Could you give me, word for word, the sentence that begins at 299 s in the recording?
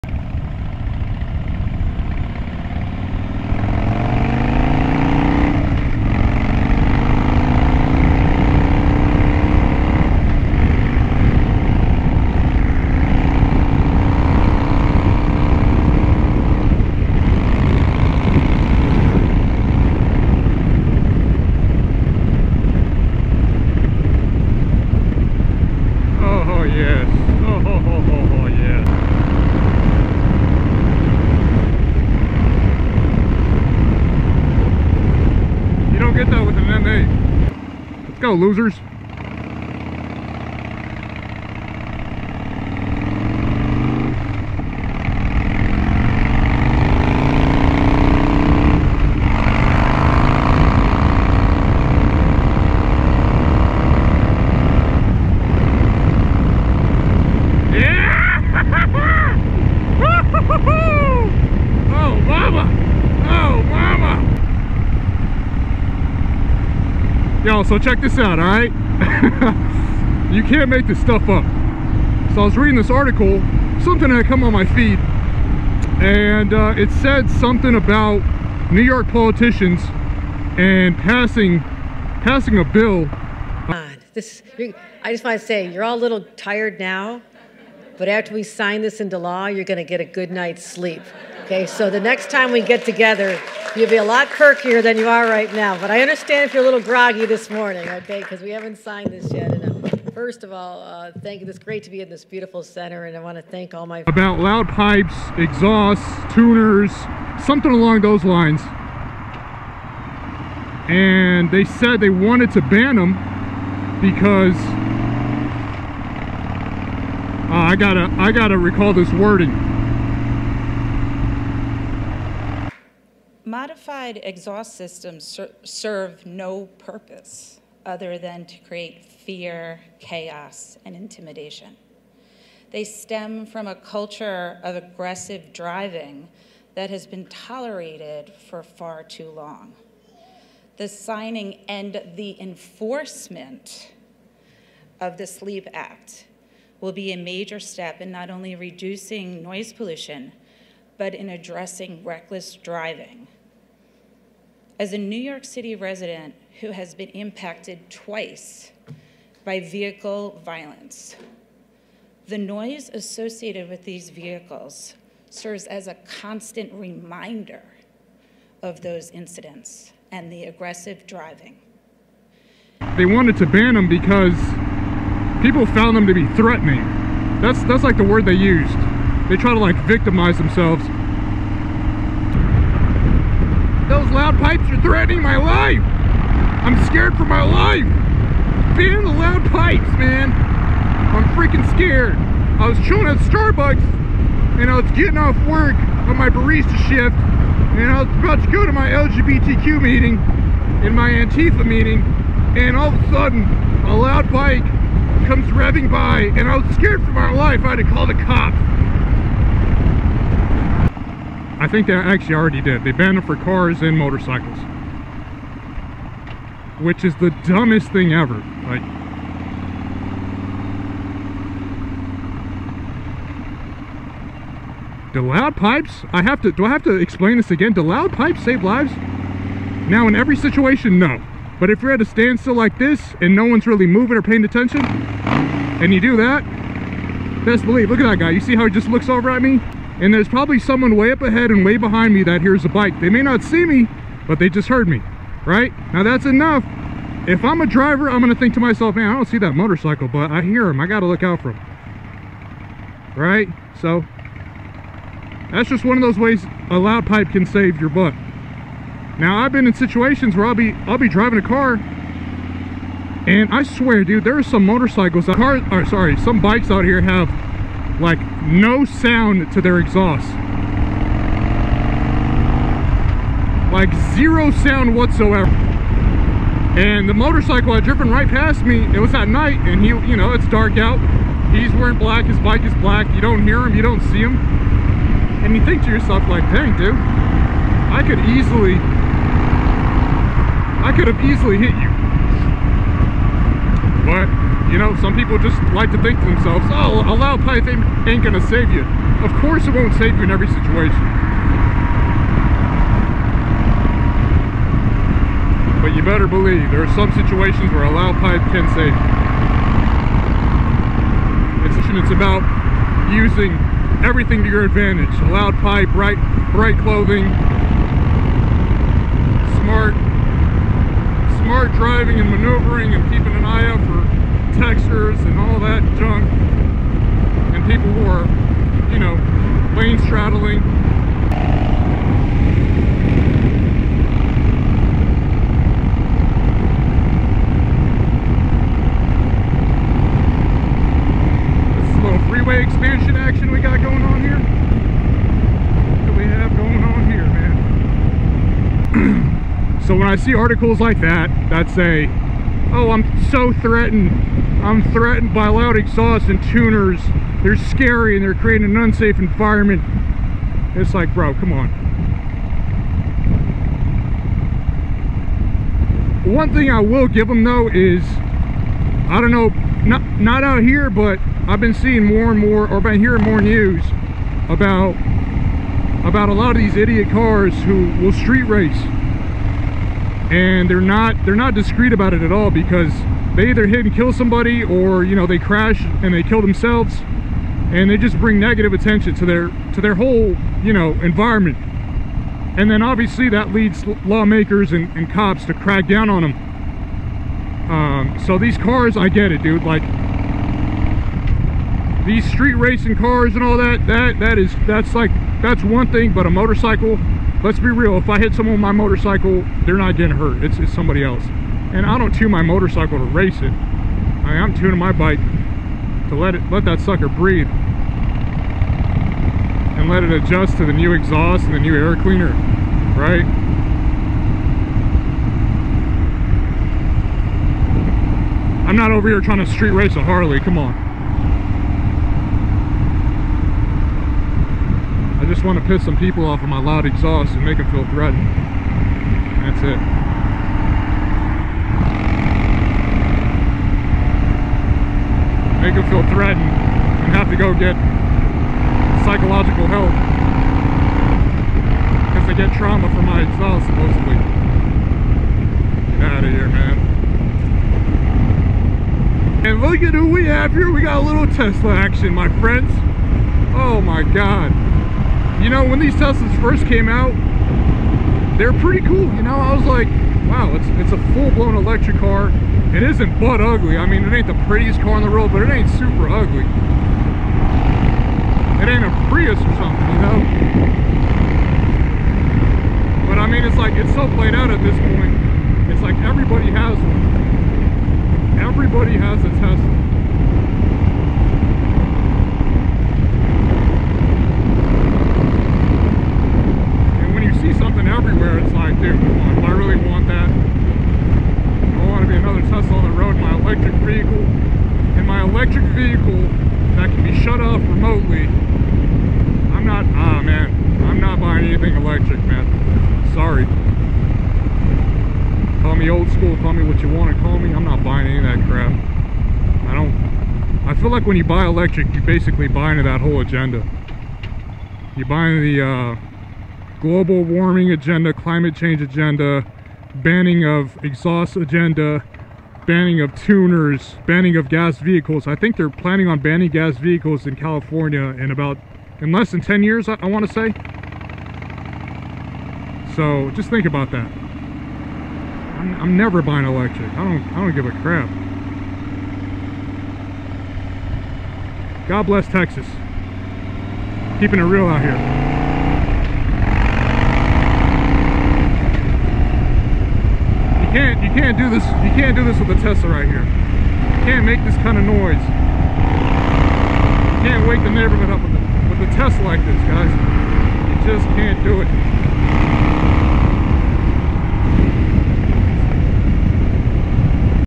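Of course it won't save you in every situation.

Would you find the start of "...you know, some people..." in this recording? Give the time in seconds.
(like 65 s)
294 s.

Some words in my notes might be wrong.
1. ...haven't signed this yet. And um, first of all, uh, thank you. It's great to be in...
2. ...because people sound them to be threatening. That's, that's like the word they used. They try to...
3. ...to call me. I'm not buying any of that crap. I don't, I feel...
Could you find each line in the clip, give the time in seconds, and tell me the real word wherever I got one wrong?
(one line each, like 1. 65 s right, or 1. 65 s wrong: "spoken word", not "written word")
1. 98 s right
2. 173 s wrong: "found", not "sound"
3. 517 s right.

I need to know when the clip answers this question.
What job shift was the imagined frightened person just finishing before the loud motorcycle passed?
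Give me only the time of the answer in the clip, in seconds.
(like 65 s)
196 s.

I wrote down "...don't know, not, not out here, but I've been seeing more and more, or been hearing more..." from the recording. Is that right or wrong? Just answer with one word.
right.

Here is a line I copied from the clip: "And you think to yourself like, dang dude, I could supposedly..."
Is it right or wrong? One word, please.
wrong.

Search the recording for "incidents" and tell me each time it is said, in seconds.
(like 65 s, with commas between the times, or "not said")
169 s.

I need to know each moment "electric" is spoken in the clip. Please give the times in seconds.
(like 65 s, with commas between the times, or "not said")
471 s, 511 s, 521 s, 546 s.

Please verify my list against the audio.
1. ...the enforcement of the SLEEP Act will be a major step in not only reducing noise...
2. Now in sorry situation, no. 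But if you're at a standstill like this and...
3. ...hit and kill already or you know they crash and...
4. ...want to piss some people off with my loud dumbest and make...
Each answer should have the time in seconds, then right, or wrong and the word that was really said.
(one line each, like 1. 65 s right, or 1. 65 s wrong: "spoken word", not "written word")
1. 142 s right
2. 229 s wrong: "every", not "sorry"
3. 383 s wrong: "somebody", not "already"
4. 435 s wrong: "exhaust", not "dumbest".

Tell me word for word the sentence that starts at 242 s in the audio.
They may not see me, but they just heard me, right?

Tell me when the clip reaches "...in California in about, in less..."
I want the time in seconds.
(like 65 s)
537 s.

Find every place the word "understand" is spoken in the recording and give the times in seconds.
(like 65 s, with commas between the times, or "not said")
96 s.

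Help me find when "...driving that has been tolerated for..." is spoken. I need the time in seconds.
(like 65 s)
135 s.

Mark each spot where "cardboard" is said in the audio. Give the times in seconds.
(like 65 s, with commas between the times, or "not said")
not said.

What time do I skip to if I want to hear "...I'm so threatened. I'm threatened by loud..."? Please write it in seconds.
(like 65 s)
352 s.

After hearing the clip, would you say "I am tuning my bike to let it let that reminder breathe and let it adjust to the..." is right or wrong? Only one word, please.
wrong.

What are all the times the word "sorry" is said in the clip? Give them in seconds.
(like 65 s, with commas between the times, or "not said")
265 s, 513 s.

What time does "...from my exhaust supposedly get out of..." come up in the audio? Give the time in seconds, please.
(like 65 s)
452 s.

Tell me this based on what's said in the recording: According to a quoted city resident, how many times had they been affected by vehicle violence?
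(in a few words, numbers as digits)
2.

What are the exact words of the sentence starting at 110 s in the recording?
And they said they wanted to ban them because uh, I gotta, I gotta recall this wording.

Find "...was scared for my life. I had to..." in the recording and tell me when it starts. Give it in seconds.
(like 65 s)
206 s.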